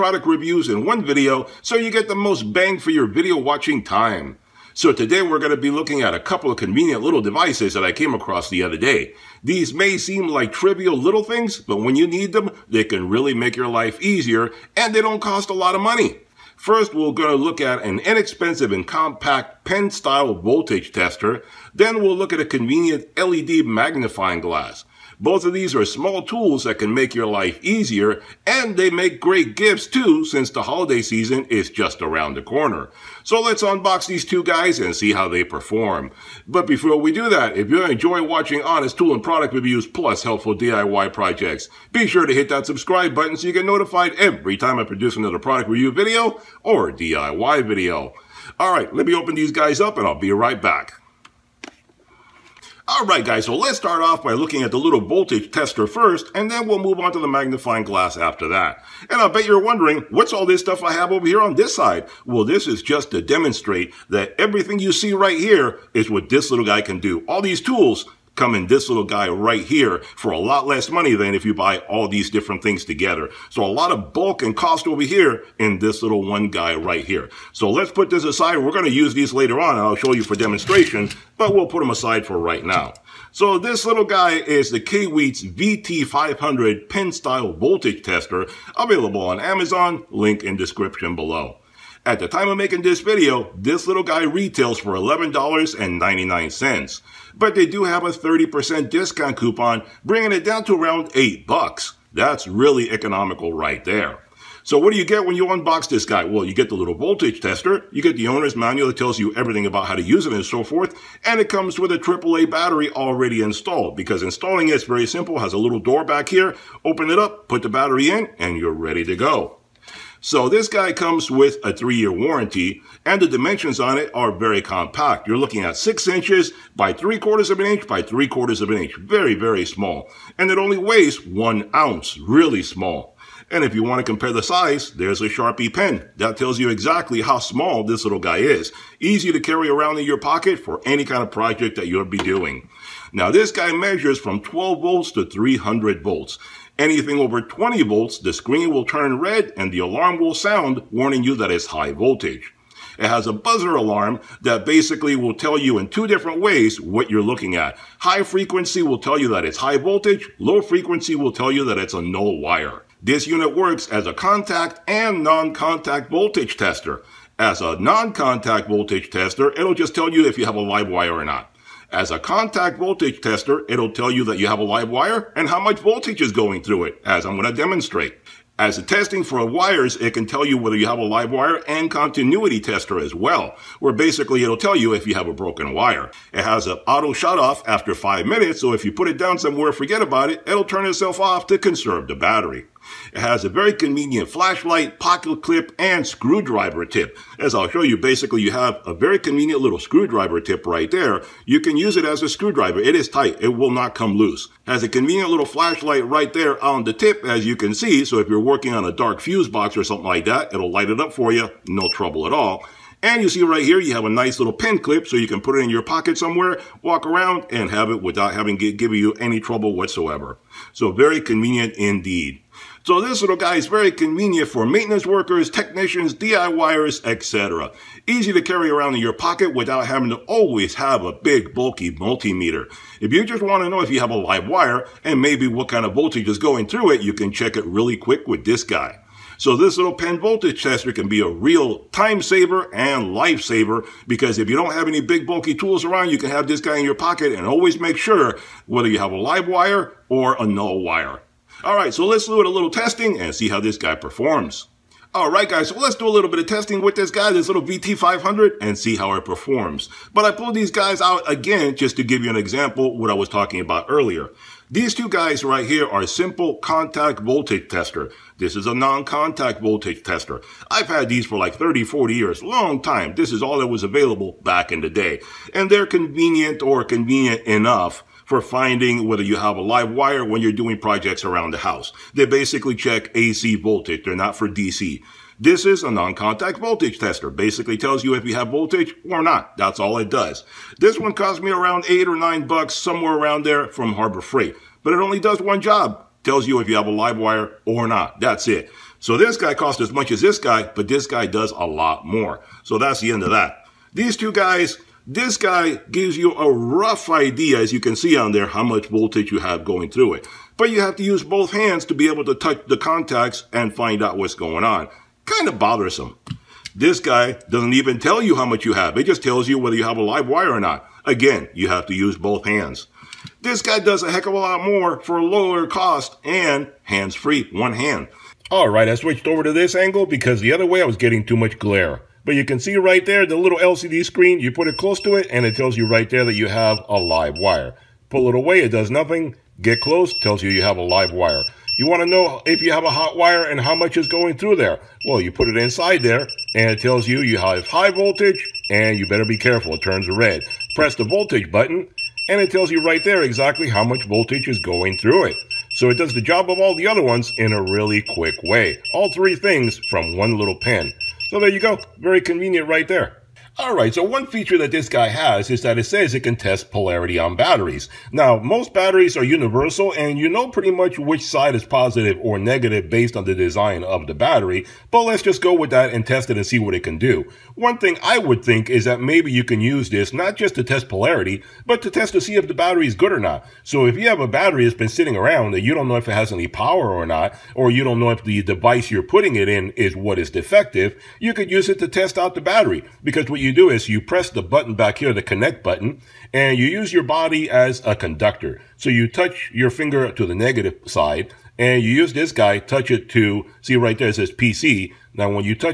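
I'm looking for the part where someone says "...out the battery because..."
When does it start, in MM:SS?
06:32.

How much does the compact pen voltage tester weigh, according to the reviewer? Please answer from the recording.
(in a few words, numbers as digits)
one ounce.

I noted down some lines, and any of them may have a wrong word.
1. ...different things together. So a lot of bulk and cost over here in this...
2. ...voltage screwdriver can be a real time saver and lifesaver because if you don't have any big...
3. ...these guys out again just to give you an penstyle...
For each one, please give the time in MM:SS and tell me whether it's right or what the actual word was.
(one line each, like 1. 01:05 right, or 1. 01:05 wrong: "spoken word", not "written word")
1. 01:12 right
2. 04:00 wrong: "tester", not "screwdriver"
3. 04:20 wrong: "example", not "penstyle".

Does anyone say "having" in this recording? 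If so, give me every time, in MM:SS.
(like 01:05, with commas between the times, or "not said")
03:38, 03:49.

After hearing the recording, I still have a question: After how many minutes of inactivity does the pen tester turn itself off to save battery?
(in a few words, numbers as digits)
5.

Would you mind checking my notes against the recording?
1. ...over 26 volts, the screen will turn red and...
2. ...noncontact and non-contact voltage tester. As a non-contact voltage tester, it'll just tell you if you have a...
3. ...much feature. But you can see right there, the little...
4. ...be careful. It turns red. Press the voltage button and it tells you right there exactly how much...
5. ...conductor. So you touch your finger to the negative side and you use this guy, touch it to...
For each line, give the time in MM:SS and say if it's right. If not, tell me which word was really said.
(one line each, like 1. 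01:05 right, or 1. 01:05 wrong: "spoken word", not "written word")
1. 02:27 wrong: "20", not "26"
2. 02:44 wrong: "contact", not "noncontact"
3. 05:31 wrong: "glare", not "feature"
4. 05:49 right
5. 06:37 right.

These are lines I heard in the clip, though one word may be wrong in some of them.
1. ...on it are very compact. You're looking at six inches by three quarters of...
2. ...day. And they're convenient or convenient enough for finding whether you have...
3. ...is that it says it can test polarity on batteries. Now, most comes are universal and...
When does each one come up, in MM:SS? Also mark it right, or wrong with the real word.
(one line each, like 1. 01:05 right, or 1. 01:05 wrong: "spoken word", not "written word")
1. 02:03 right
2. 04:34 right
3. 06:05 wrong: "batteries", not "comes".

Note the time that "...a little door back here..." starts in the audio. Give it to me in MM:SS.
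01:55.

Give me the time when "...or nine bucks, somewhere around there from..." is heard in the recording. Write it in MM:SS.
04:52.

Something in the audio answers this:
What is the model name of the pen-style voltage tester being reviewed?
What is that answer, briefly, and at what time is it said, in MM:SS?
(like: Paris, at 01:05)
Kaiweets VT500, at 01:24.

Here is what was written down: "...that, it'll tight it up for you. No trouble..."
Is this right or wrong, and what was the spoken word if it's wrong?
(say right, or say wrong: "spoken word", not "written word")
wrong: "light", not "tight".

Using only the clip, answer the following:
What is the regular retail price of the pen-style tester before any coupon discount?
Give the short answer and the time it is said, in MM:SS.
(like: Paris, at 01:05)
$11.99, at 01:34.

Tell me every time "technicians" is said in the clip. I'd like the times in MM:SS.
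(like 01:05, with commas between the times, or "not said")
03:45.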